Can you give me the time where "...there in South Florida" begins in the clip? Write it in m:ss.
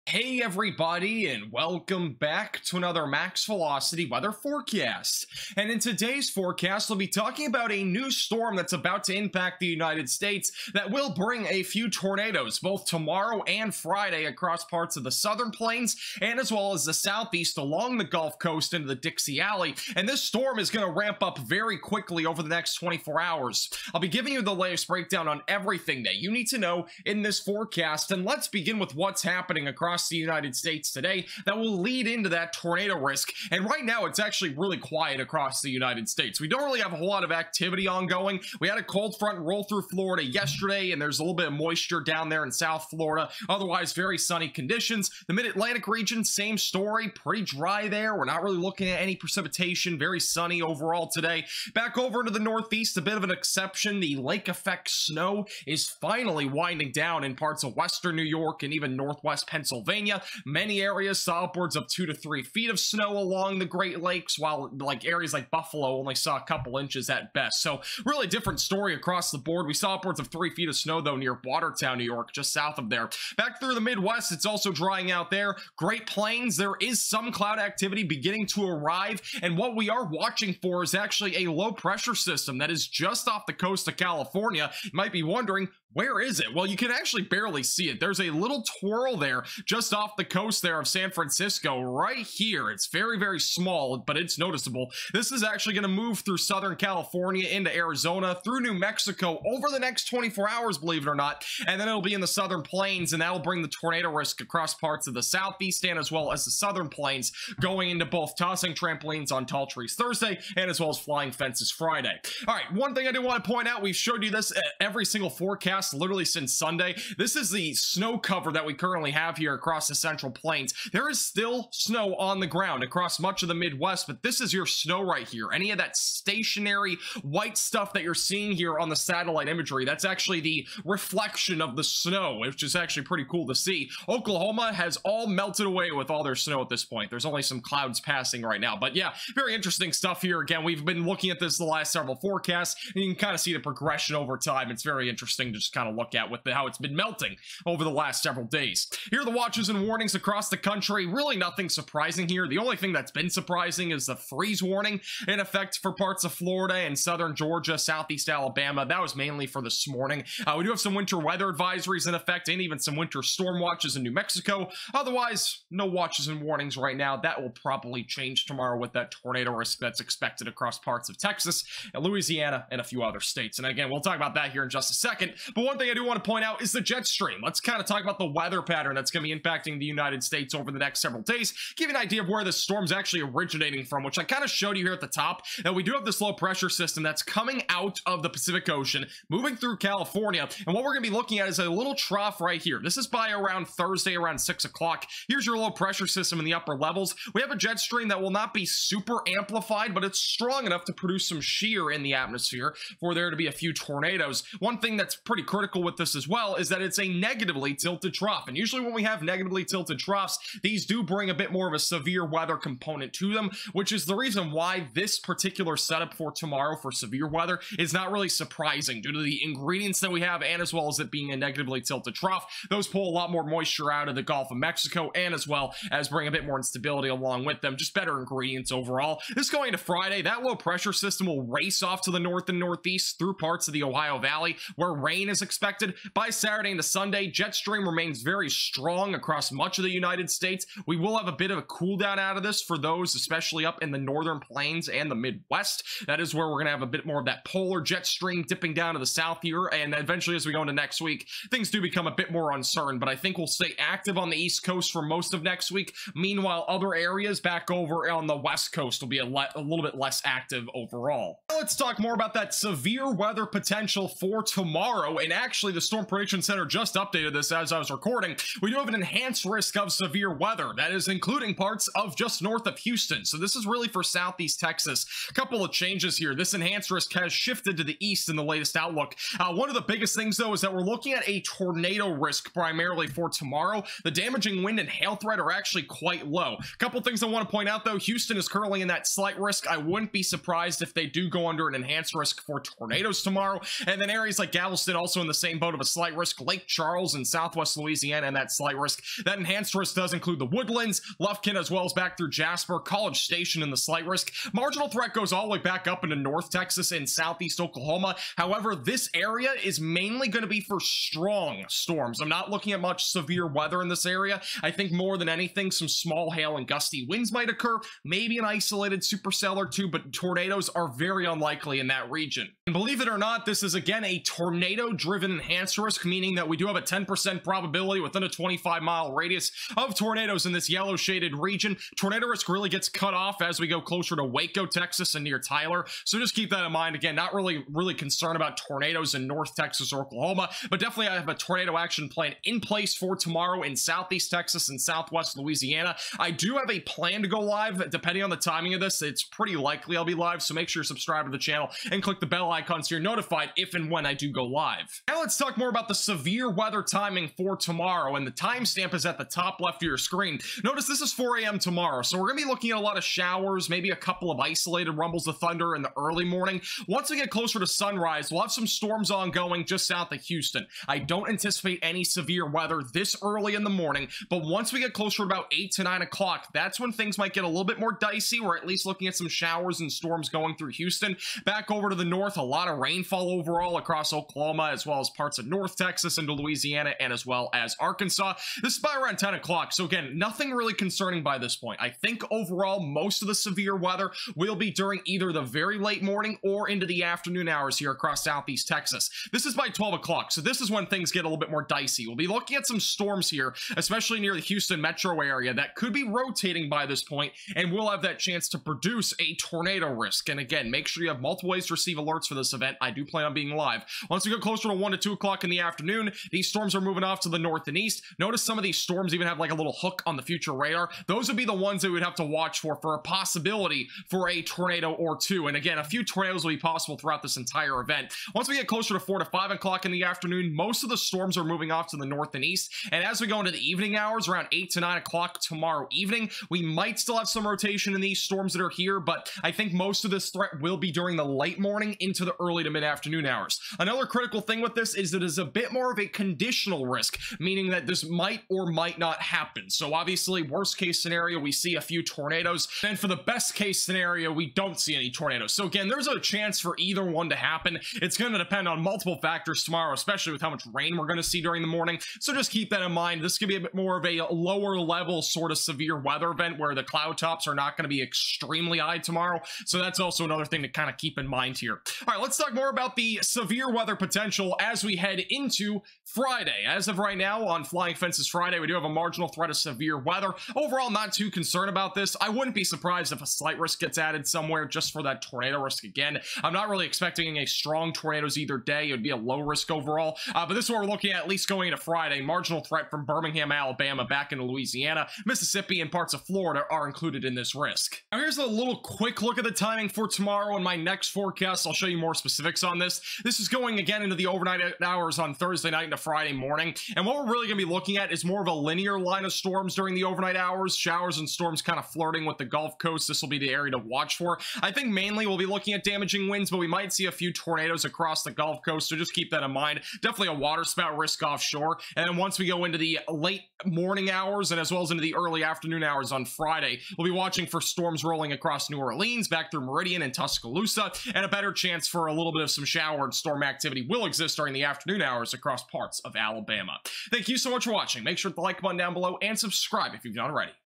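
0:42.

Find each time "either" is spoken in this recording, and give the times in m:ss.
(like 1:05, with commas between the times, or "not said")
6:35, 7:36, 8:08.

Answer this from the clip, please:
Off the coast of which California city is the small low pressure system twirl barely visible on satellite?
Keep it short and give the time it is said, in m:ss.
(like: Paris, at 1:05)
San Francisco, at 1:30.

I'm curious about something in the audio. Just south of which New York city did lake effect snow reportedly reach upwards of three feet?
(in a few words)
Watertown.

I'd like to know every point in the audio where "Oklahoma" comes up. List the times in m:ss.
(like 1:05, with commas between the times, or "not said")
2:14, 5:07, 5:40, 6:24.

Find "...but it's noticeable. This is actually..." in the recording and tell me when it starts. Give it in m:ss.
1:33.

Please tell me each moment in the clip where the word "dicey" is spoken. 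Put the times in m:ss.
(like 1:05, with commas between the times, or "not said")
6:17, 6:41.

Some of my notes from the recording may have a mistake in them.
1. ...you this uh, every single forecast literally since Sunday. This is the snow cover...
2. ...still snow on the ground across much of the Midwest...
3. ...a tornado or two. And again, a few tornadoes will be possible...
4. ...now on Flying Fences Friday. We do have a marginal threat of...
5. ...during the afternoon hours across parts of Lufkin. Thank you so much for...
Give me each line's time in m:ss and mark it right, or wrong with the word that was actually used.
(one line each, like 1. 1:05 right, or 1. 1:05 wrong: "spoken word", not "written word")
1. 1:54 right
2. 2:01 right
3. 7:04 right
4. 7:57 right
5. 8:54 wrong: "Alabama", not "Lufkin".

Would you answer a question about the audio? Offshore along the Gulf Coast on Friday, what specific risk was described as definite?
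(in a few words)
waterspout risk.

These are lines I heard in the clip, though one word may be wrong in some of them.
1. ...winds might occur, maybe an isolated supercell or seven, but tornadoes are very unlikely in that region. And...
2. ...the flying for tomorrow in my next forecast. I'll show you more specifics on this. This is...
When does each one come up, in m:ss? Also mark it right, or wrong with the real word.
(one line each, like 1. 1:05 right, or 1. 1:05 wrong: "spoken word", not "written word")
1. 5:17 wrong: "two", not "seven"
2. 8:19 wrong: "timing", not "flying".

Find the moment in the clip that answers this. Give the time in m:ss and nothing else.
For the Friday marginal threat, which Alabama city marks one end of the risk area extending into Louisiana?
8:13.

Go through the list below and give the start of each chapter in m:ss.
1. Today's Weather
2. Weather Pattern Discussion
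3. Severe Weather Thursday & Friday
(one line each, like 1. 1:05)
1. 0:28
2. 2:55
3. 4:21.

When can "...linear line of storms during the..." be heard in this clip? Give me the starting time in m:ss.
8:28.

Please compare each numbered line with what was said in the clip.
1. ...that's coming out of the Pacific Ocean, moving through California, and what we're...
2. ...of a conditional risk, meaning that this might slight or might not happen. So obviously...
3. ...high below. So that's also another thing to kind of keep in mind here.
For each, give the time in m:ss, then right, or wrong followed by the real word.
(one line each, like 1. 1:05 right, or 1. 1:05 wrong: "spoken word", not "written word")
1. 3:07 right
2. 7:25 wrong: "might", not "slight"
3. 7:48 wrong: "tomorrow", not "below".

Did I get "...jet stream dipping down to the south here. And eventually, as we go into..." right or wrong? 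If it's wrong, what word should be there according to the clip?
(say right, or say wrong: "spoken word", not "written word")
right.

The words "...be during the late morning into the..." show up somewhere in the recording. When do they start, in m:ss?
7:20.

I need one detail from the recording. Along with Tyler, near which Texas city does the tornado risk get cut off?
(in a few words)
Waco.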